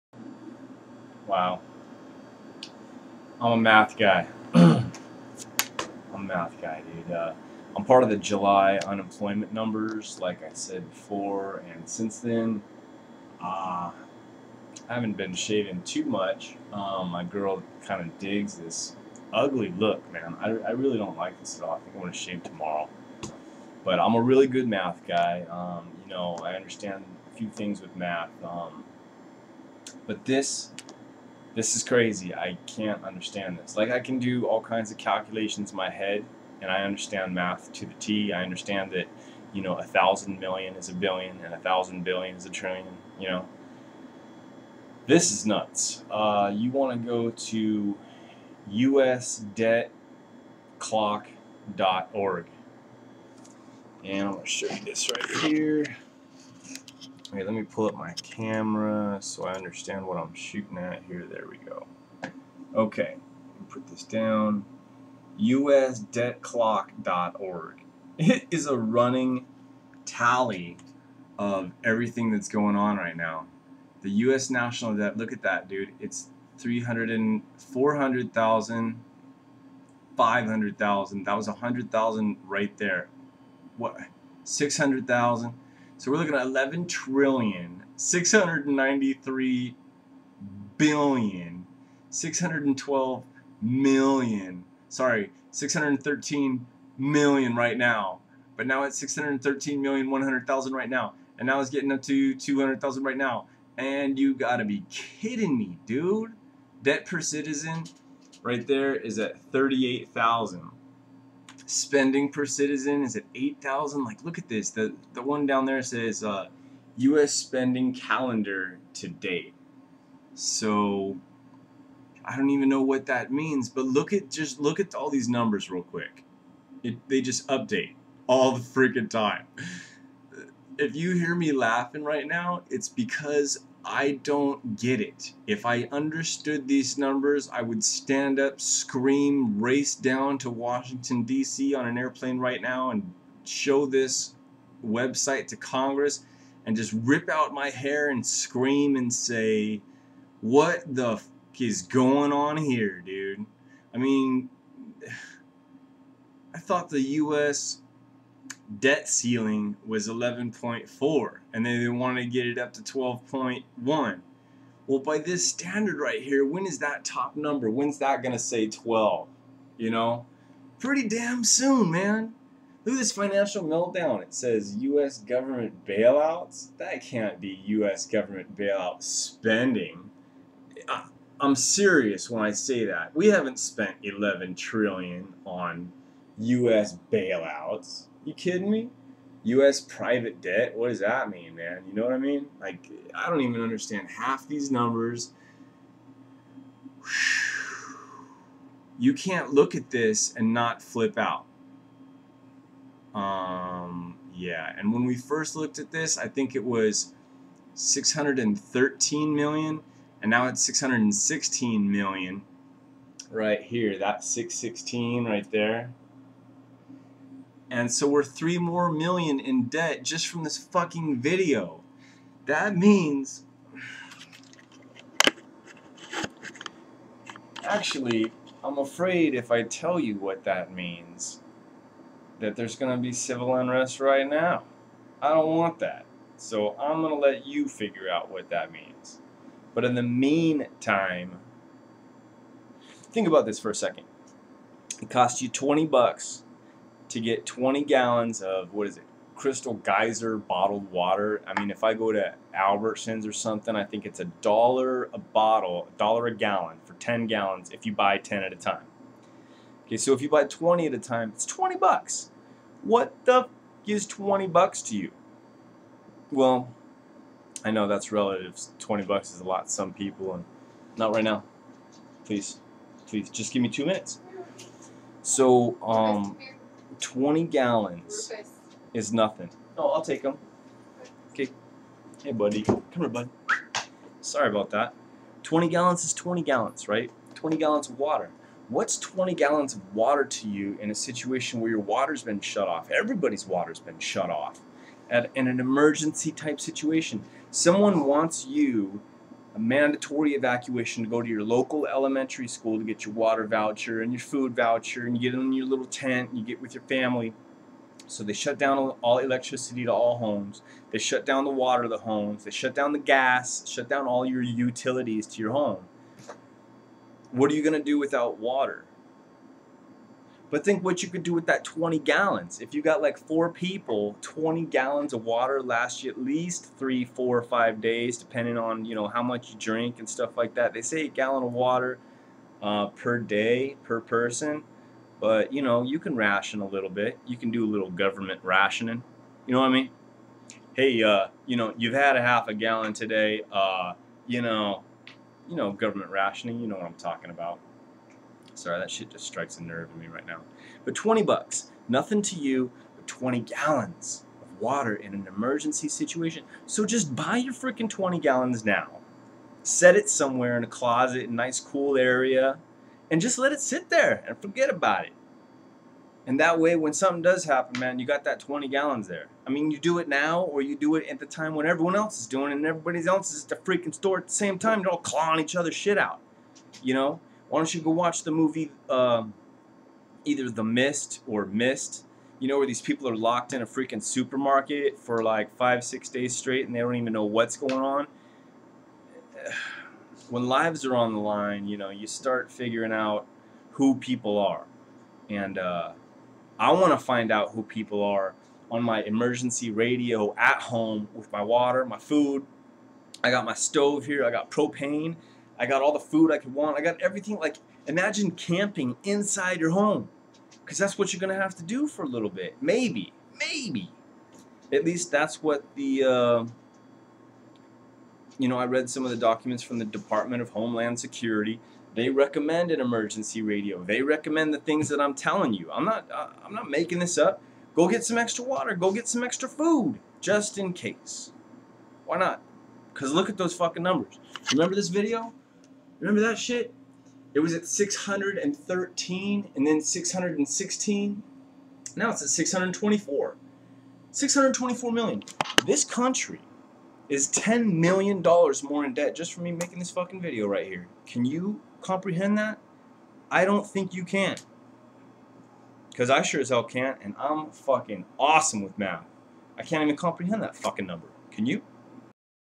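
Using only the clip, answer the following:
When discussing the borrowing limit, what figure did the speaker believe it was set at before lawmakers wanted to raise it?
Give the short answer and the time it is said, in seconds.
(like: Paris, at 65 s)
11.4, at 160 s.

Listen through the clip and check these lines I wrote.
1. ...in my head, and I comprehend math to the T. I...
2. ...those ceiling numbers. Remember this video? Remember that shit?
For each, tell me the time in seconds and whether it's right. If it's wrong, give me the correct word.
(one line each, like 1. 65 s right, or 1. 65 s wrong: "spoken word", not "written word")
1. 35 s wrong: "understand", not "comprehend"
2. 433 s wrong: "fucking", not "ceiling".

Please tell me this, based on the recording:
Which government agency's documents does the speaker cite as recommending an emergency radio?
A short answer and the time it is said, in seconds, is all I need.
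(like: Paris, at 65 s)
Department of Homeland Security, at 419 s.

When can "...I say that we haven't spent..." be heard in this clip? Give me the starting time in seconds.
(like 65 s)
182 s.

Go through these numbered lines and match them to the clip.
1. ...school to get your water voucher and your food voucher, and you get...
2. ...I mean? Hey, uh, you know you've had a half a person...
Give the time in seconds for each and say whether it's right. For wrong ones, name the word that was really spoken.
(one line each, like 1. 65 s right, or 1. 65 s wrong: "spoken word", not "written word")
1. 302 s right
2. 339 s wrong: "gallon", not "person".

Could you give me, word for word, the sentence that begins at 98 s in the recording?
But now it's 613 million 100,000 right now.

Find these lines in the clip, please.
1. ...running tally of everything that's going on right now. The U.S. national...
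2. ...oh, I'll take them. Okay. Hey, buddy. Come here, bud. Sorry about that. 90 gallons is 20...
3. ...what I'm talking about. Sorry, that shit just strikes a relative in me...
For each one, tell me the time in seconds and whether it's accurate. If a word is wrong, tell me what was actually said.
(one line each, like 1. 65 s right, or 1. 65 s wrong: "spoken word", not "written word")
1. 68 s right
2. 279 s wrong: "20", not "90"
3. 346 s wrong: "nerve", not "relative".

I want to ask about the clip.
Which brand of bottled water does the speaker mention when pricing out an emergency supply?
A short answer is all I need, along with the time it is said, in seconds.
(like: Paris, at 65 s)
Crystal Geyser, at 249 s.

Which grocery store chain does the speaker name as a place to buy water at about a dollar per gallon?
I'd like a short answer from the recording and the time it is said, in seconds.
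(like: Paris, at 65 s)
Albertsons, at 252 s.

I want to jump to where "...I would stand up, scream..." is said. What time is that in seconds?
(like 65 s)
137 s.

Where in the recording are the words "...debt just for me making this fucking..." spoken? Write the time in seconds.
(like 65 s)
448 s.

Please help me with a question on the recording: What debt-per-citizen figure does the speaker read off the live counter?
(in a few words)
38,000.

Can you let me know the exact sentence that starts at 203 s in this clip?
Um, yeah, and when we first looked at this, I think it was 613 million, and now it's 616 million right here.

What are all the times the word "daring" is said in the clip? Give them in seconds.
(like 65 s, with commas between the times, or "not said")
not said.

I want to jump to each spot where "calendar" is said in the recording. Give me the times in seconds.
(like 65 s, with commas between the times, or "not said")
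117 s.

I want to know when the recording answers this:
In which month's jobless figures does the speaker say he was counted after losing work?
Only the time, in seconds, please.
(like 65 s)
8 s.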